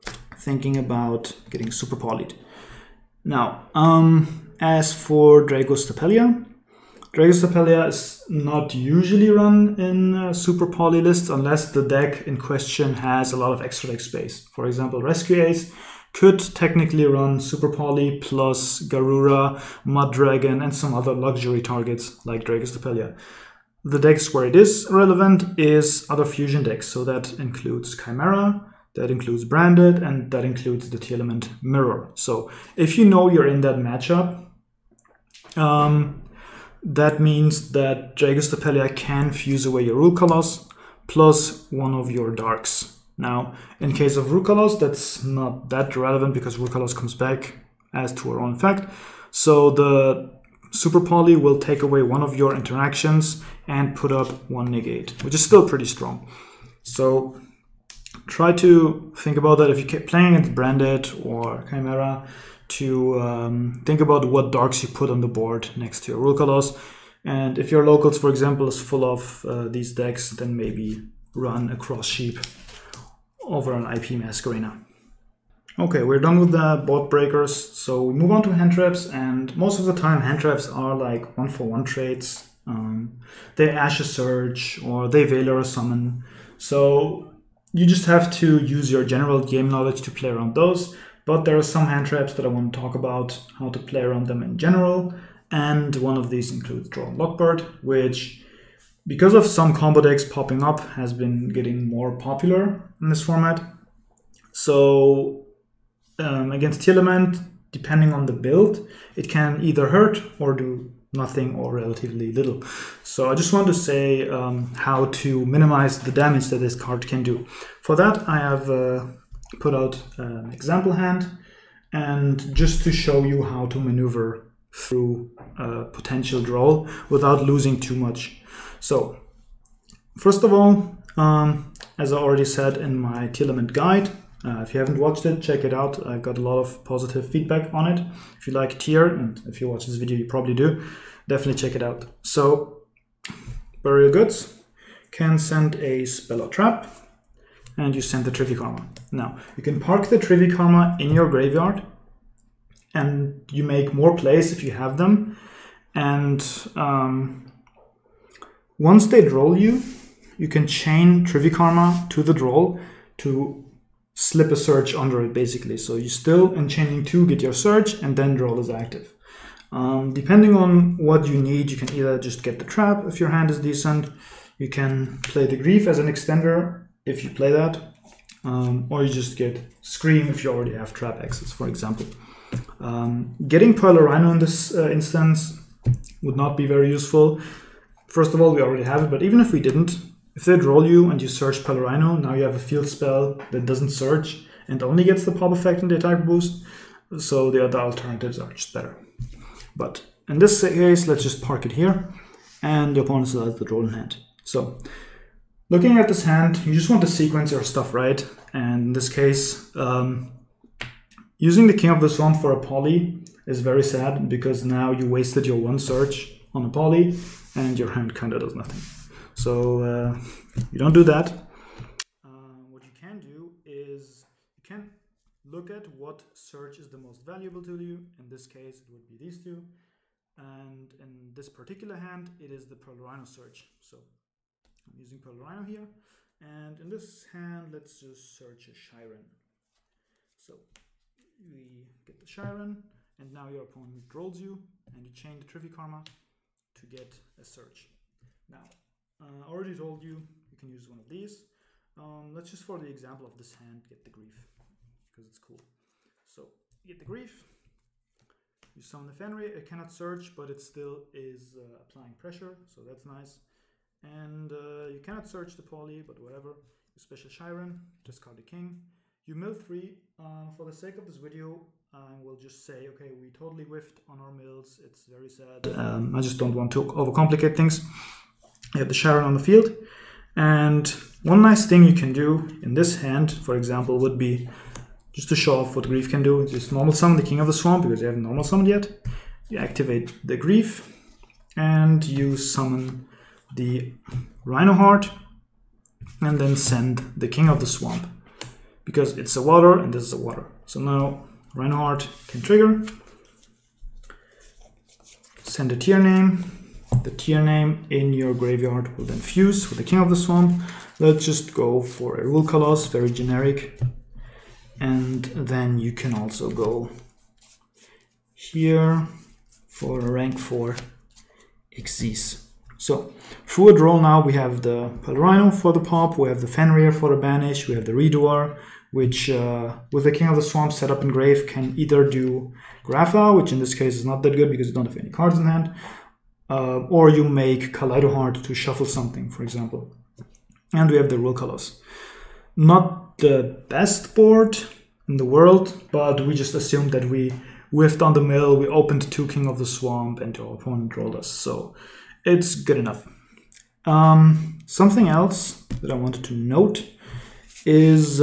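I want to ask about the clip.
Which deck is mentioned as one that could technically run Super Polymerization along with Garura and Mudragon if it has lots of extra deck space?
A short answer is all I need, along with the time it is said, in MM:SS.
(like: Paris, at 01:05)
Rescue Ace, at 00:15.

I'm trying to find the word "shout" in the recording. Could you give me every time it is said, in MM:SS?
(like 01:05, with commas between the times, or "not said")
not said.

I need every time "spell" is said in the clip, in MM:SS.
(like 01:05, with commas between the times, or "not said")
02:26, 03:12.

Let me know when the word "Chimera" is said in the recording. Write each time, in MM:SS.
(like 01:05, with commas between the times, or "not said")
00:27, 01:01.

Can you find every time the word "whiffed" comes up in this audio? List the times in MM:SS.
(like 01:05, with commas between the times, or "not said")
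04:33, 05:47.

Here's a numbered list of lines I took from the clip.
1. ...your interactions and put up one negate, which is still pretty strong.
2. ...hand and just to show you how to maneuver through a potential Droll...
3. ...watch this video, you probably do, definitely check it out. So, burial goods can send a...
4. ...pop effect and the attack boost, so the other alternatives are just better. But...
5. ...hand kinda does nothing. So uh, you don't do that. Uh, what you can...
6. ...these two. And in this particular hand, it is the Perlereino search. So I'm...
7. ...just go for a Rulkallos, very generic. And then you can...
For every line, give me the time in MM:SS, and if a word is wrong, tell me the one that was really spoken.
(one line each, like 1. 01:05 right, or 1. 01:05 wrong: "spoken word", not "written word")
1. 00:52 right
2. 02:00 right
3. 02:19 right
4. 03:15 right
5. 03:37 right
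6. 03:49 right
7. 05:11 right.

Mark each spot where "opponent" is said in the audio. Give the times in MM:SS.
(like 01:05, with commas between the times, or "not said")
03:23, 04:03, 05:50.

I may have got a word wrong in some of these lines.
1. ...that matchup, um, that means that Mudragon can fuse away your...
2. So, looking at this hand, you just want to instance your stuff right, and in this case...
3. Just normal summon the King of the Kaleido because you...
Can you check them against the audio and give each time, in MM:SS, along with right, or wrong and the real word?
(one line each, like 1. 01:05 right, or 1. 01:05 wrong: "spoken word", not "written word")
1. 00:33 wrong: "Jagus", not "Mudragon"
2. 03:24 wrong: "sequence", not "instance"
3. 04:46 wrong: "Swamp", not "Kaleido".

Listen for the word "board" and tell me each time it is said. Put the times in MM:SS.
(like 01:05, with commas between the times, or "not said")
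01:05, 01:16, 05:44.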